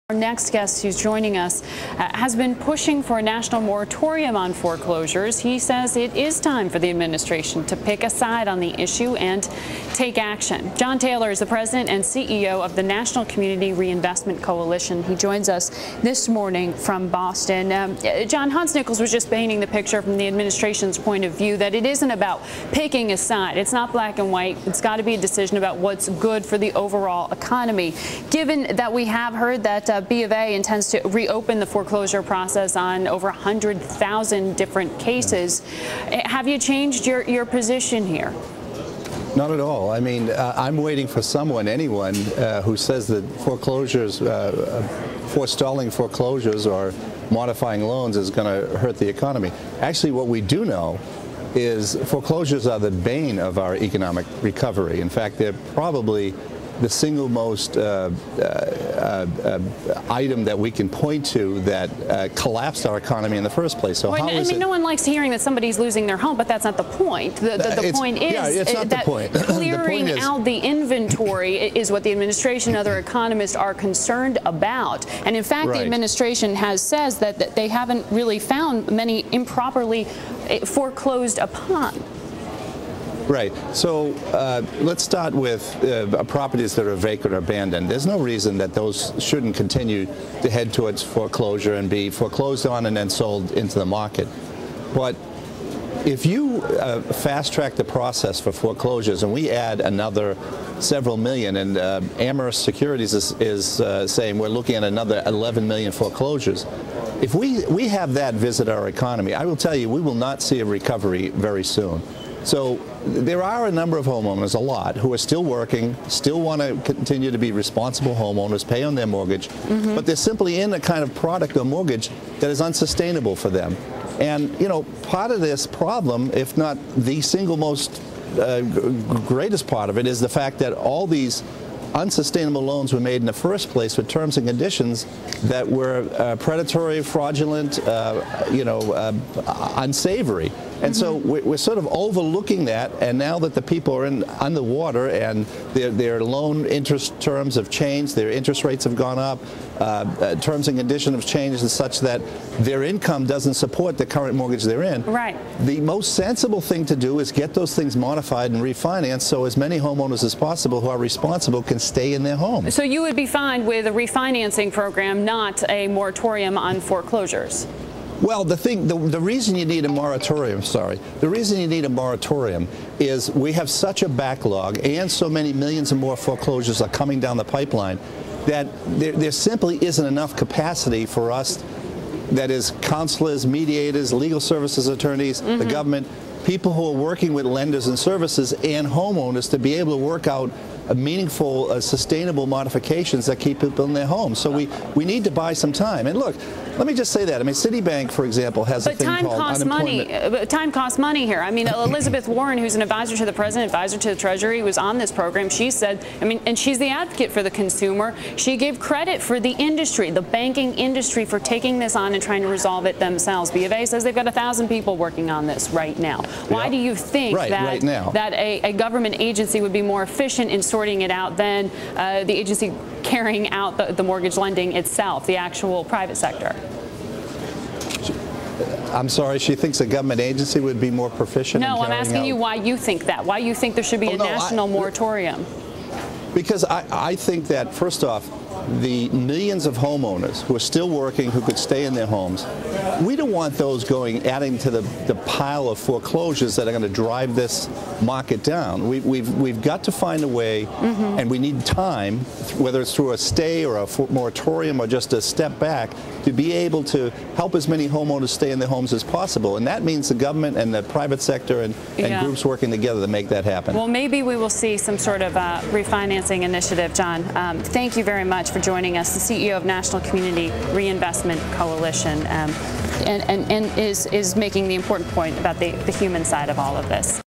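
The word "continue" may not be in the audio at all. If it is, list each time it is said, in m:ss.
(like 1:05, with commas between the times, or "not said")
1:29, 1:56.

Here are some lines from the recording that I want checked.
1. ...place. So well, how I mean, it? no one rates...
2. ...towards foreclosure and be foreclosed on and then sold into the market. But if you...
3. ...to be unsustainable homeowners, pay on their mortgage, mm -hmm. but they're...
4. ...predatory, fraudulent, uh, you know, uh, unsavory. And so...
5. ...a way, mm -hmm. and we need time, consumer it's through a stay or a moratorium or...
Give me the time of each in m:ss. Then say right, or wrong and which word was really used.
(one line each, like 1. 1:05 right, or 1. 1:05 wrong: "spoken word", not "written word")
1. 1:03 wrong: "likes", not "rates"
2. 1:30 right
3. 1:57 wrong: "responsible", not "unsustainable"
4. 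2:16 right
5. 4:10 wrong: "whether", not "consumer".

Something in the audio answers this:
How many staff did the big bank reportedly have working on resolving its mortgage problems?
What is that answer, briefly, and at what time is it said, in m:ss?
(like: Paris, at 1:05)
1,000, at 3:34.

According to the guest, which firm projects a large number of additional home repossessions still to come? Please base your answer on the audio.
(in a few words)
Amherst Securities.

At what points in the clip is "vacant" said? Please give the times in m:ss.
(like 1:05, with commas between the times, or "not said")
1:26.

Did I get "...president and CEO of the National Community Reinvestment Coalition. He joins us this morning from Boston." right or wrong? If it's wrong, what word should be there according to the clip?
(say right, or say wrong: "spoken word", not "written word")
right.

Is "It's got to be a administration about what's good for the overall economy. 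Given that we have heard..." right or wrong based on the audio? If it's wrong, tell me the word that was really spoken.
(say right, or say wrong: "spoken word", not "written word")
wrong: "decision", not "administration".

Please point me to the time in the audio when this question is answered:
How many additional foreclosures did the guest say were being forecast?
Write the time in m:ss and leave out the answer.
1:45.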